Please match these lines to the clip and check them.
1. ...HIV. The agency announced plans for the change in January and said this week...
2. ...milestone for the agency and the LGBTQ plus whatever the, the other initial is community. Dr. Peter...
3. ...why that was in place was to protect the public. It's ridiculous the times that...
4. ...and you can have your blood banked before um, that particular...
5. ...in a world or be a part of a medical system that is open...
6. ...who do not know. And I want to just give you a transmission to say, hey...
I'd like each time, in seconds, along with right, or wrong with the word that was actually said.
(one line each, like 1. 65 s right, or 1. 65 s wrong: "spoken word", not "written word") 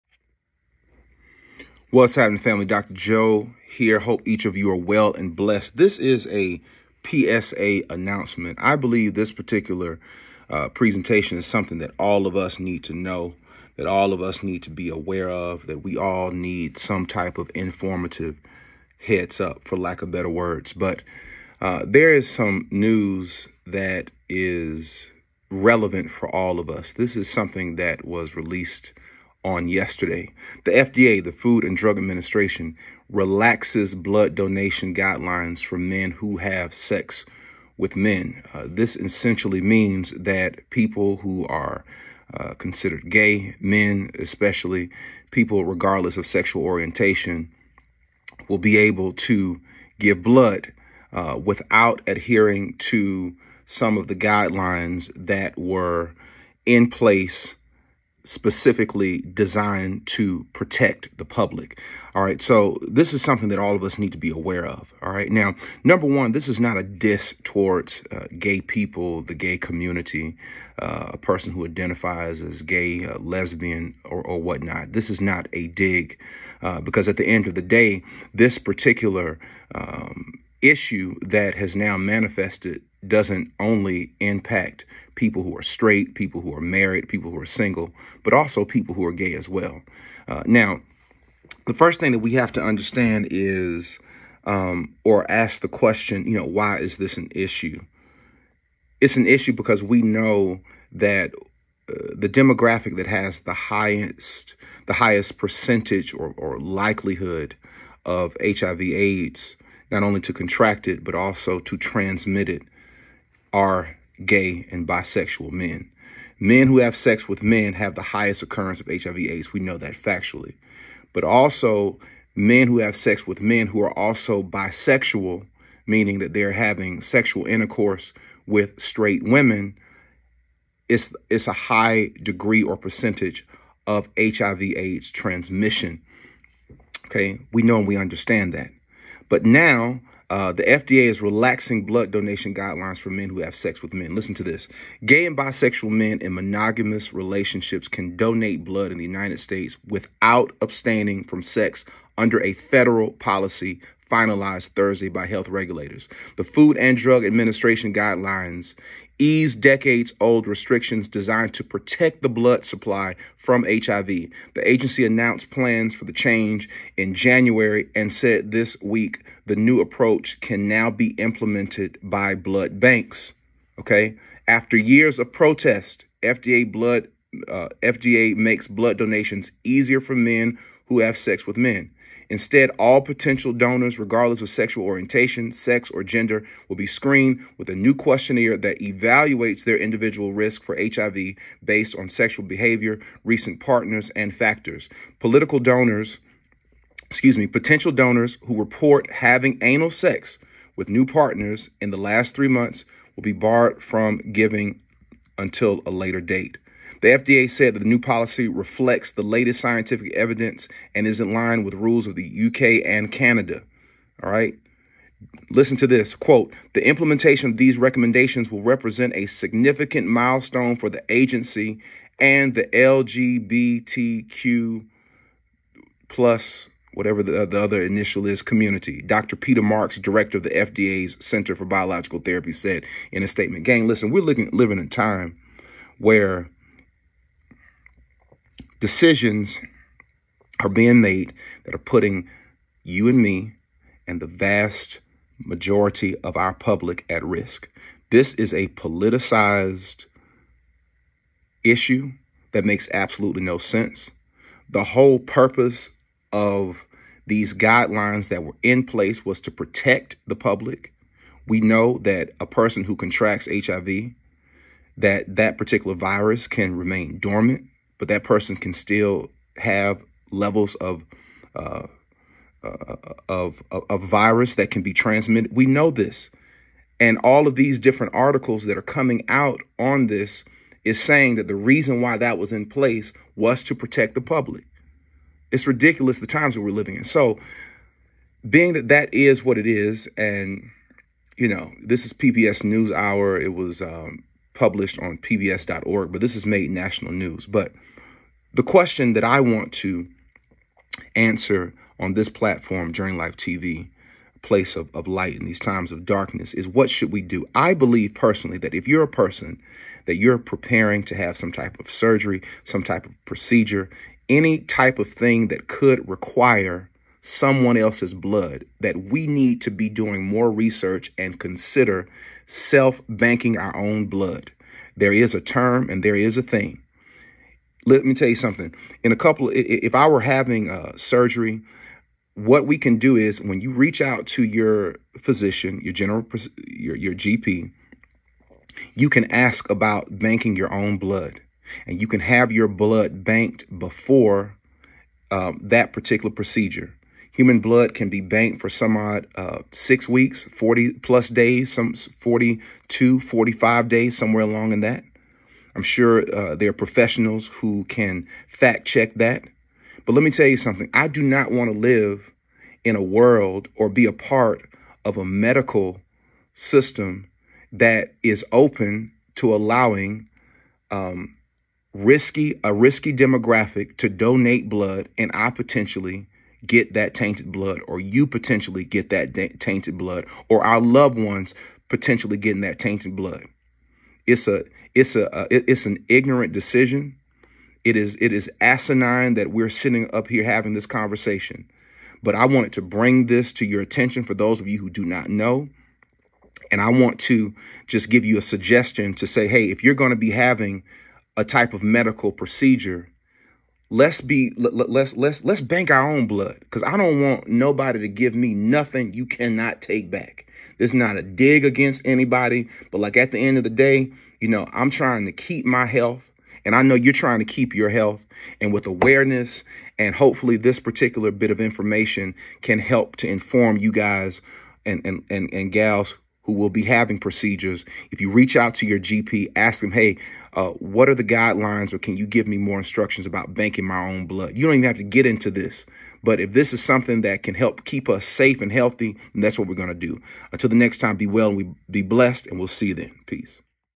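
1. 163 s right
2. 220 s right
3. 282 s right
4. 341 s right
5. 362 s right
6. 394 s wrong: "suggestion", not "transmission".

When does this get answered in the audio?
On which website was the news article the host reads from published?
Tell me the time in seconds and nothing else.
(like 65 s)
295 s.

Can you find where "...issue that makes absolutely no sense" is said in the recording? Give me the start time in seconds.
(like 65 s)
251 s.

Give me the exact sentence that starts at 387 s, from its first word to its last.
It is it is asinine that we're sitting up here having this conversation.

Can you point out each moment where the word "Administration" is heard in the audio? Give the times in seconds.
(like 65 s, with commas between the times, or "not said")
31 s, 157 s.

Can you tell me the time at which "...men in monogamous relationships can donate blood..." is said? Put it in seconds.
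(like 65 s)
145 s.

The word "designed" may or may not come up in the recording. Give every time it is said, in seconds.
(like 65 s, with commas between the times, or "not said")
59 s, 161 s.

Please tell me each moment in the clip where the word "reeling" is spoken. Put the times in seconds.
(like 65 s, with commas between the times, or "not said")
not said.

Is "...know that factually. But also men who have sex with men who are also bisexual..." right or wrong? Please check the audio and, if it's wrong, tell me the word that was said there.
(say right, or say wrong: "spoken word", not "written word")
right.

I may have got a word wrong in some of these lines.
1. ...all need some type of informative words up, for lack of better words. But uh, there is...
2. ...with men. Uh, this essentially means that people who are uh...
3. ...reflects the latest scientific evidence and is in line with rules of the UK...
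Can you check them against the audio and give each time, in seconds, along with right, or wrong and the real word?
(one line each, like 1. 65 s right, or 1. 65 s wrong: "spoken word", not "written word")
1. 15 s wrong: "heads", not "words"
2. 37 s right
3. 208 s right.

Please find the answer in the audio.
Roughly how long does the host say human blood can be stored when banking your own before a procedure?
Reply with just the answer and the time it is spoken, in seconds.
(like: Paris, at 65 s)
6 weeks, at 349 s.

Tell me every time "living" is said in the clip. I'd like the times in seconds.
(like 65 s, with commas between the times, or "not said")
234 s, 286 s.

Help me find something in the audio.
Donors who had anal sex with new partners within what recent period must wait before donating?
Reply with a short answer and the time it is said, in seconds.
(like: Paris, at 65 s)
3 months, at 202 s.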